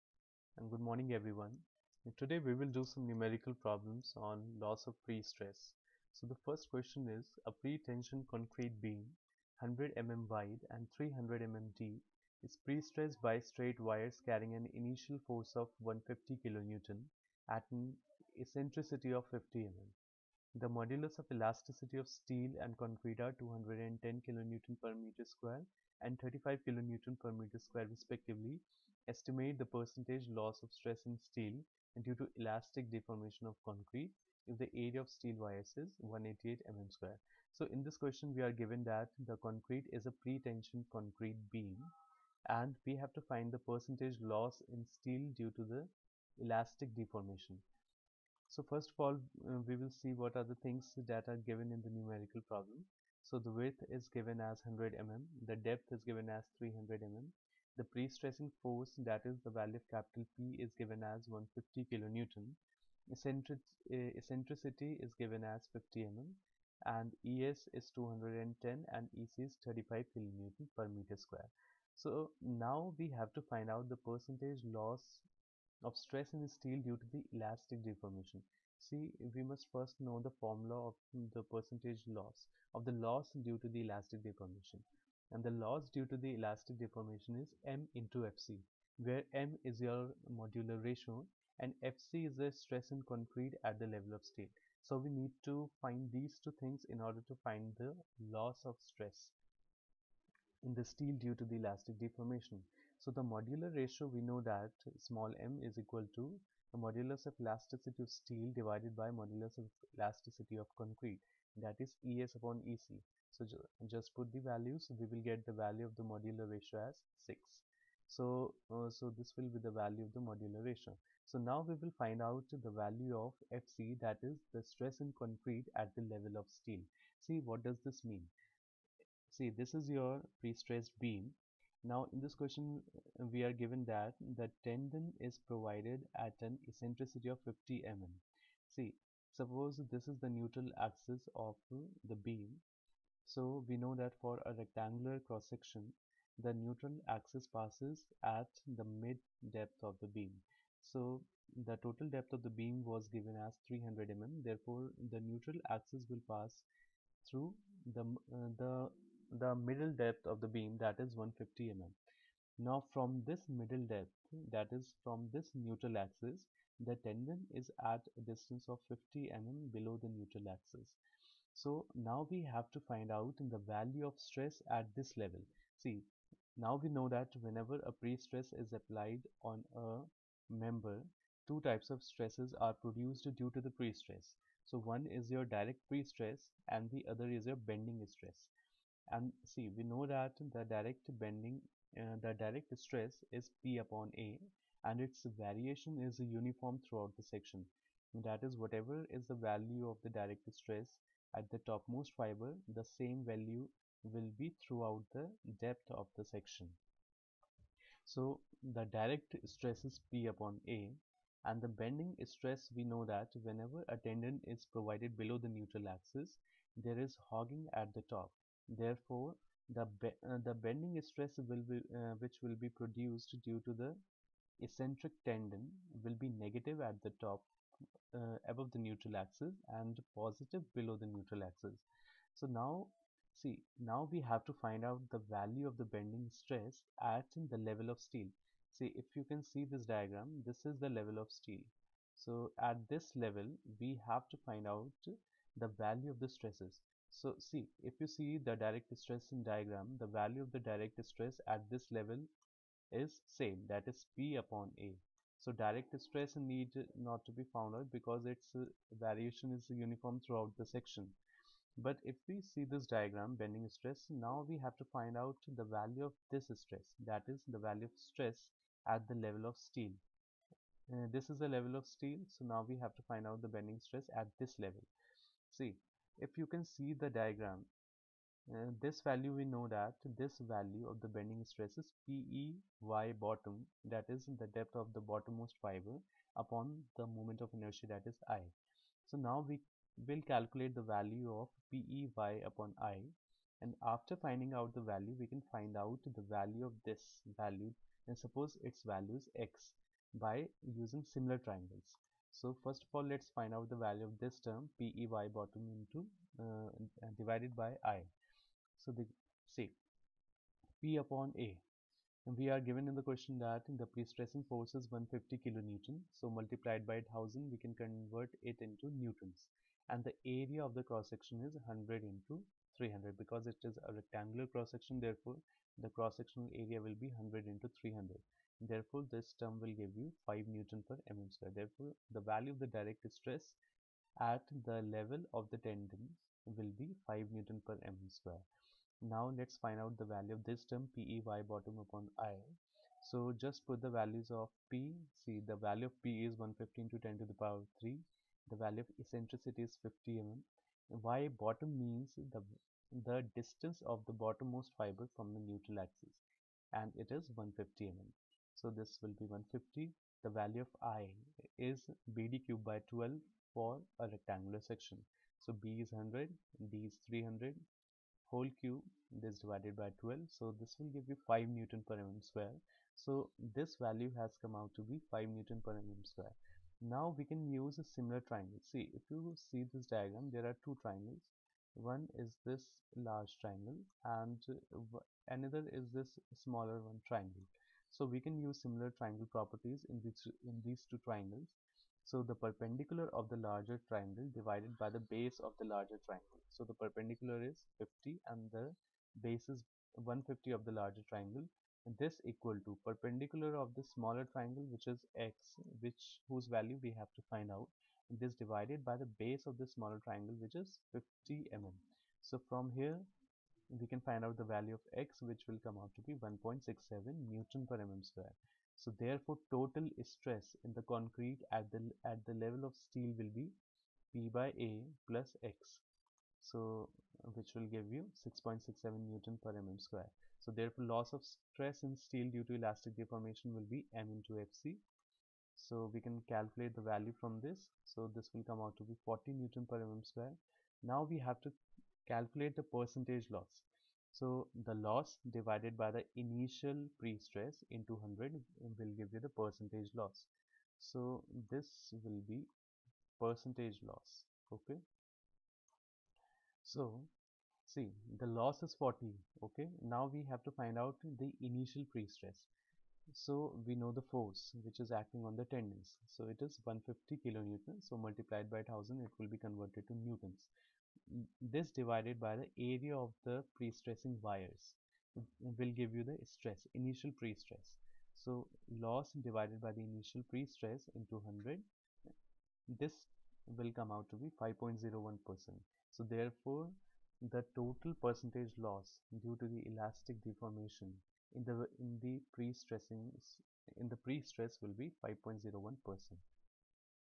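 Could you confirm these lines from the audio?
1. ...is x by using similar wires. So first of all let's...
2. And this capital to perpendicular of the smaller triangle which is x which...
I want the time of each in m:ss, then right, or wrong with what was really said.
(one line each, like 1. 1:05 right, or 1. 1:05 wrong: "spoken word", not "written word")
1. 4:59 wrong: "triangles", not "wires"
2. 6:41 wrong: "equal", not "capital".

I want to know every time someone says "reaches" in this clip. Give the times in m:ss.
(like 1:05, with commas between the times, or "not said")
not said.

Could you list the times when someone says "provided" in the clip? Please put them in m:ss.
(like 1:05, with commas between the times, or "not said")
2:15, 3:34.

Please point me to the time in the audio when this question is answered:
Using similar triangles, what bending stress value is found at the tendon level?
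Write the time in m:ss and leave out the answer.
6:56.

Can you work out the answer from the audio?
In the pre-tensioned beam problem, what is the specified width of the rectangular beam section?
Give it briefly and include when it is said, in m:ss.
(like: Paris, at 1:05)
100 mm, at 0:09.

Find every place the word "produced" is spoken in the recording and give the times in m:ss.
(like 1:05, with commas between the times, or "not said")
3:02, 3:42.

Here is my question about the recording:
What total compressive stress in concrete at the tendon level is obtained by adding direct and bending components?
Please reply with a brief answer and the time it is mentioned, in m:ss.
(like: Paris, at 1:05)
6.67 N/mm², at 7:08.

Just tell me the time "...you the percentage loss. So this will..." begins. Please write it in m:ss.
7:29.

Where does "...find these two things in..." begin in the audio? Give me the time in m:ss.
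1:35.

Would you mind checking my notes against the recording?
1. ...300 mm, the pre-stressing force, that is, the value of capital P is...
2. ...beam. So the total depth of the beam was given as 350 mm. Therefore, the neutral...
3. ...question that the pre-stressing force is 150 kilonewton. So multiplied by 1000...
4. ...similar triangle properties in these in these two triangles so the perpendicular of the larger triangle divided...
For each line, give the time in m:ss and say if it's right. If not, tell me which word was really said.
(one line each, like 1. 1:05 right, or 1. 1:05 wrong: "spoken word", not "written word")
1. 0:56 right
2. 2:30 wrong: "300", not "350"
3. 5:13 right
4. 6:28 right.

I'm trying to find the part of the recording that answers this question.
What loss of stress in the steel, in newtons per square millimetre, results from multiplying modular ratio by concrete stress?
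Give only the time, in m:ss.
7:19.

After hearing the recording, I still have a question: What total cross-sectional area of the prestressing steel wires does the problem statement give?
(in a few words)
188 mm square.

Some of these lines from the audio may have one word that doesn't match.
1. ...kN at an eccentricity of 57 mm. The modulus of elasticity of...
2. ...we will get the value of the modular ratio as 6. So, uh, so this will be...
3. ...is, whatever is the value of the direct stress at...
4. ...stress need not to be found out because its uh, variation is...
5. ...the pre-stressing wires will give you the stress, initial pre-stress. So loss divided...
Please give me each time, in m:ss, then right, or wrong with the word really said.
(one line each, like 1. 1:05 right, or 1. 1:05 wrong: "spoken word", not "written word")
1. 0:16 wrong: "50", not "57"
2. 1:54 right
3. 3:18 right
4. 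4:16 right
5. 7:53 right.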